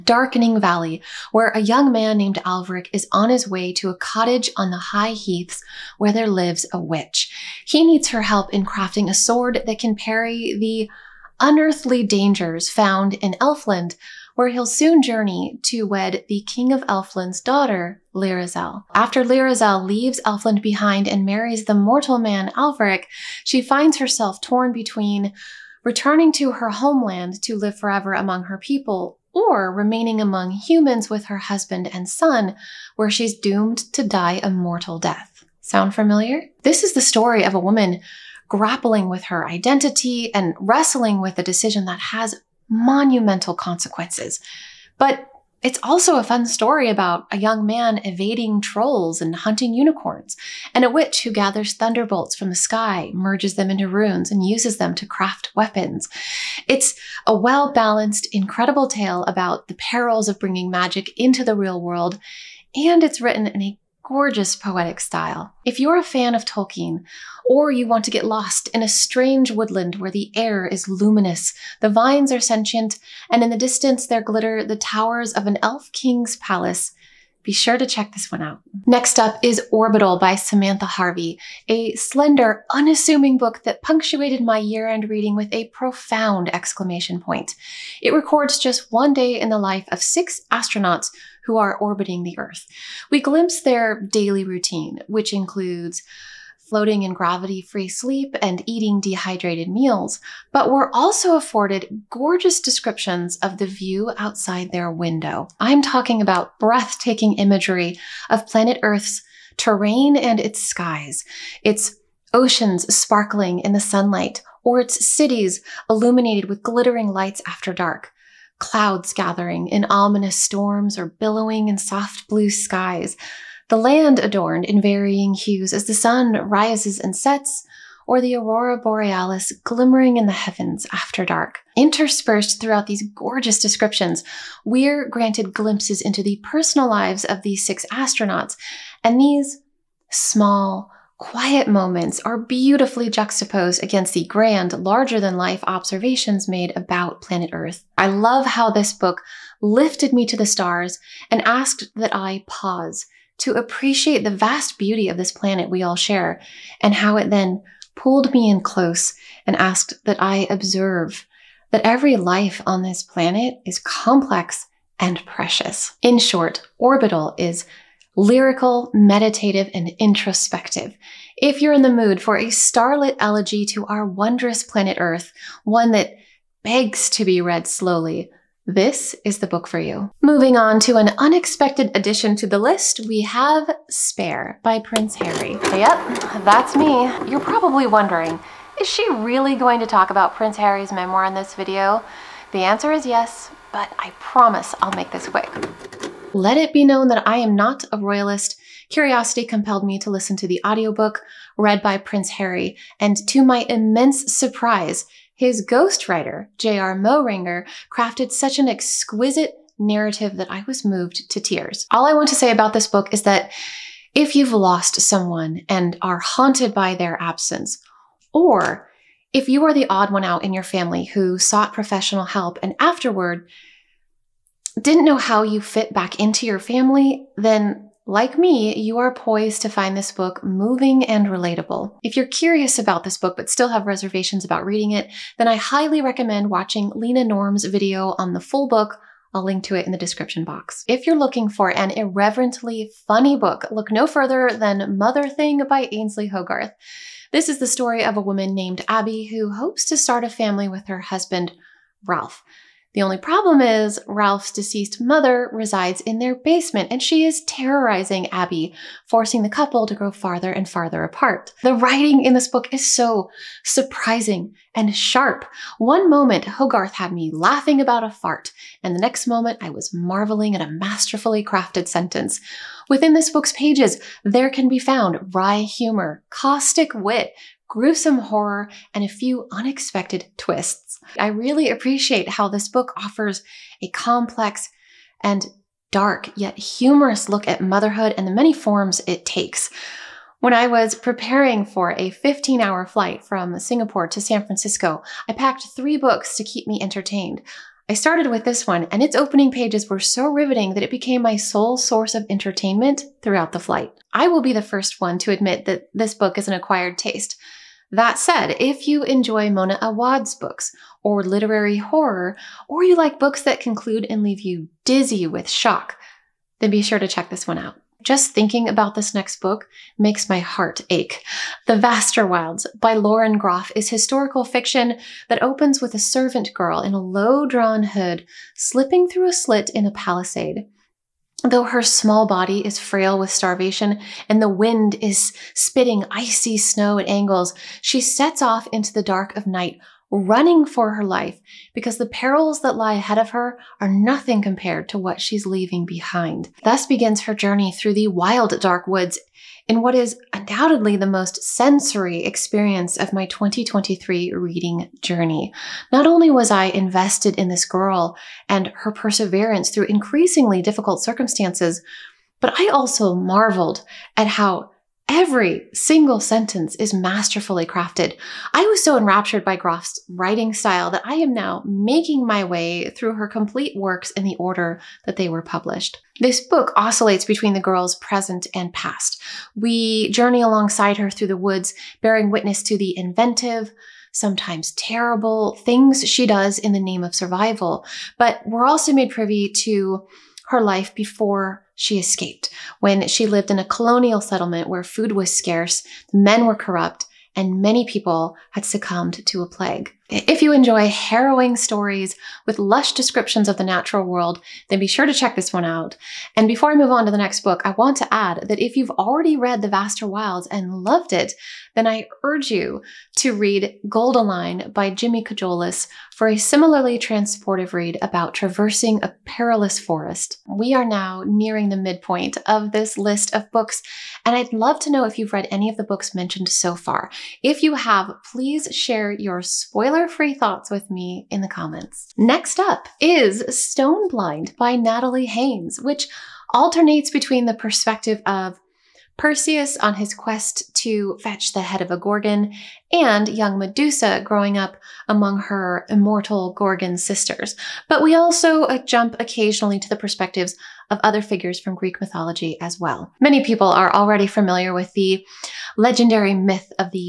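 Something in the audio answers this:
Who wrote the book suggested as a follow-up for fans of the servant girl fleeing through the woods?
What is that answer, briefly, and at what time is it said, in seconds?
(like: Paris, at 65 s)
Jimmy Cajoleas, at 414 s.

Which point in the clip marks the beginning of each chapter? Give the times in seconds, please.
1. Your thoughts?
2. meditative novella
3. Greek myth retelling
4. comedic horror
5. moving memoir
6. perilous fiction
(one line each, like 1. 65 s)
1. 419 s
2. 77 s
3. 431 s
4. 240 s
5. 178 s
6. 318 s.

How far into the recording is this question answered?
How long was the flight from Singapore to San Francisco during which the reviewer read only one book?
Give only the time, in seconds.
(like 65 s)
292 s.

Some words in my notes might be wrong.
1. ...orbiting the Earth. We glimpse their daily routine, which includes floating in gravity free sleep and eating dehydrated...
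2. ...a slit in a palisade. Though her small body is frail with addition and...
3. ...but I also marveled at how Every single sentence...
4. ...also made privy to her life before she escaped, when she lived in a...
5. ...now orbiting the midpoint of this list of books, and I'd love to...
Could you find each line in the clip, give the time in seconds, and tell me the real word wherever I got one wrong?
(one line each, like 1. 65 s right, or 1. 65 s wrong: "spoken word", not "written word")
1. 91 s right
2. 329 s wrong: "starvation", not "addition"
3. 362 s right
4. 388 s right
5. 420 s wrong: "nearing", not "orbiting".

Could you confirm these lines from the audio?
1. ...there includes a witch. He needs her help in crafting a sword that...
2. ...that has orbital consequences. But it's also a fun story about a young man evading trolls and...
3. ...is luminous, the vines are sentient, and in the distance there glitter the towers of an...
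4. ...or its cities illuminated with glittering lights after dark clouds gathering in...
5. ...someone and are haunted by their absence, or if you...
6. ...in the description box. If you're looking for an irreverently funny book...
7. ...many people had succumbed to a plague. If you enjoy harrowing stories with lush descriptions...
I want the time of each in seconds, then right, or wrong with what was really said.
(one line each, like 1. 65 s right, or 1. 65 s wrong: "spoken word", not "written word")
1. 6 s wrong: "lives", not "includes"
2. 41 s wrong: "monumental", not "orbital"
3. 70 s right
4. 114 s right
5. 215 s right
6. 239 s right
7. 397 s right.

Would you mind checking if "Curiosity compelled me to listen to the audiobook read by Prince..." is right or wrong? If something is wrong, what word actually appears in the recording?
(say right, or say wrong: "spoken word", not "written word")
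right.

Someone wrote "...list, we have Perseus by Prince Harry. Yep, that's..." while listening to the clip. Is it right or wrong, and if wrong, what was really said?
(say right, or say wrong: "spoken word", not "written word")
wrong: "Spare", not "Perseus".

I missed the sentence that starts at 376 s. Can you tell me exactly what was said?
This book oscillates between the girl's present and past.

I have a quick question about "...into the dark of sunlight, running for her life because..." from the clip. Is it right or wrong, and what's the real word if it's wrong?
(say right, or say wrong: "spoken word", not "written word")
wrong: "night", not "sunlight".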